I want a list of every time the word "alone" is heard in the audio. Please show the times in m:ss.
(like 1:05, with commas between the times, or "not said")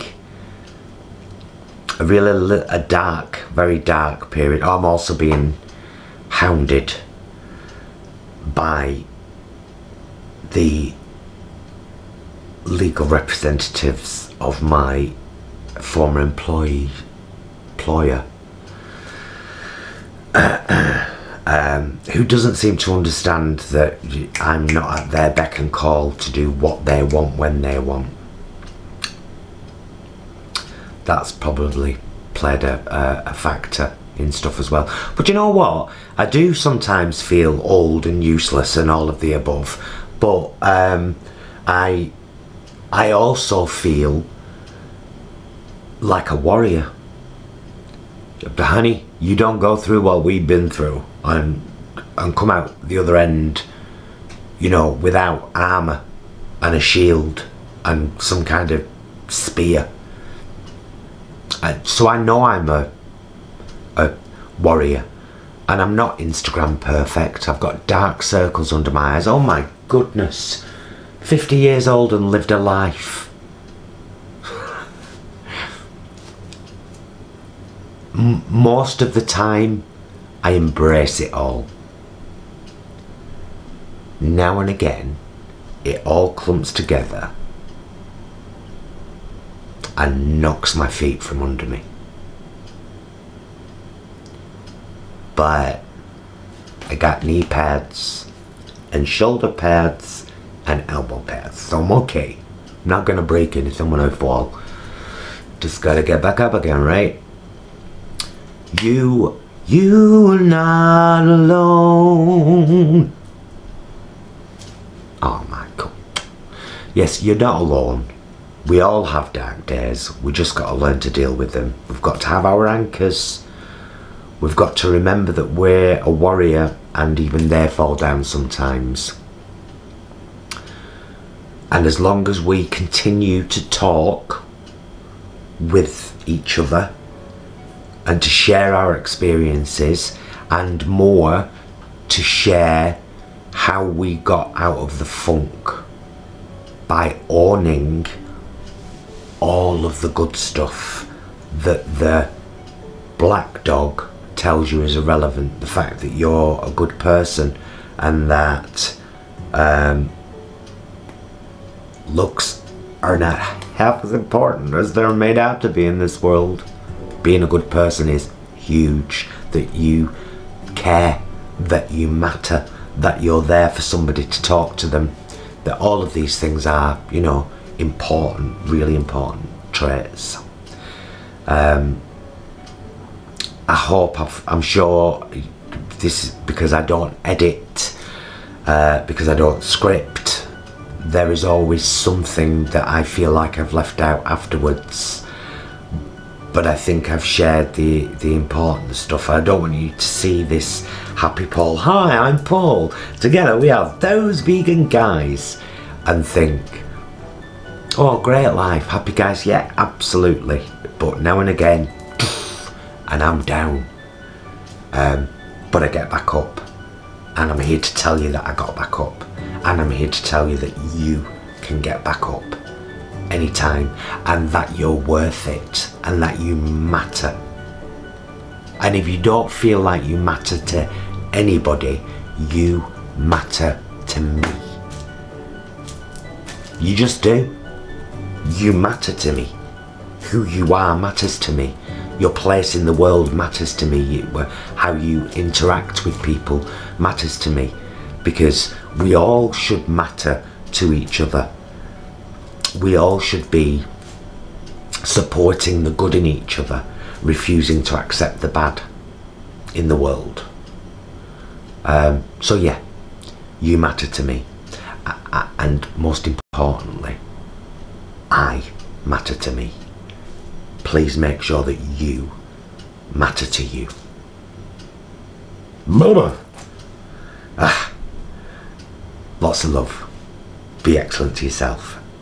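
1:51, 1:57.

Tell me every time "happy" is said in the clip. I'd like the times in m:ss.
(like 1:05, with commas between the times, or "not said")
3:21, 3:28.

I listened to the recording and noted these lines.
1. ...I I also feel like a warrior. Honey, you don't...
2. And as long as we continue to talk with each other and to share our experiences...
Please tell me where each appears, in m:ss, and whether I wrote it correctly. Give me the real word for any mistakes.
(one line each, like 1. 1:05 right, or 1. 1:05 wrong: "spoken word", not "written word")
1. 0:41 right
2. 2:11 right.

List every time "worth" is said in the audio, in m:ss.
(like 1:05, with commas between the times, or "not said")
3:45.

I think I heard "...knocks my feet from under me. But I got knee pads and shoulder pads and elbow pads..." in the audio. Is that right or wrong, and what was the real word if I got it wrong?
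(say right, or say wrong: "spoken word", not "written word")
right.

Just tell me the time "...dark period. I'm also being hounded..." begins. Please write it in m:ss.
0:03.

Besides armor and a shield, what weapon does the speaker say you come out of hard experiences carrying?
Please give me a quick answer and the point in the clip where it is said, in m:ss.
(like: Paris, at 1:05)
spear, at 0:59.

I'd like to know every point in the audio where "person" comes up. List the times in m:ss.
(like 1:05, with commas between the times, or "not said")
2:36, 2:47.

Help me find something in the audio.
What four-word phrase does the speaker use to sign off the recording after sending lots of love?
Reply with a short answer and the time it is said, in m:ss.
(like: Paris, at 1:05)
Be excellent to yourself, at 4:40.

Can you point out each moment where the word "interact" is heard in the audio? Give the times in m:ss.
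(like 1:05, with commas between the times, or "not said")
4:05.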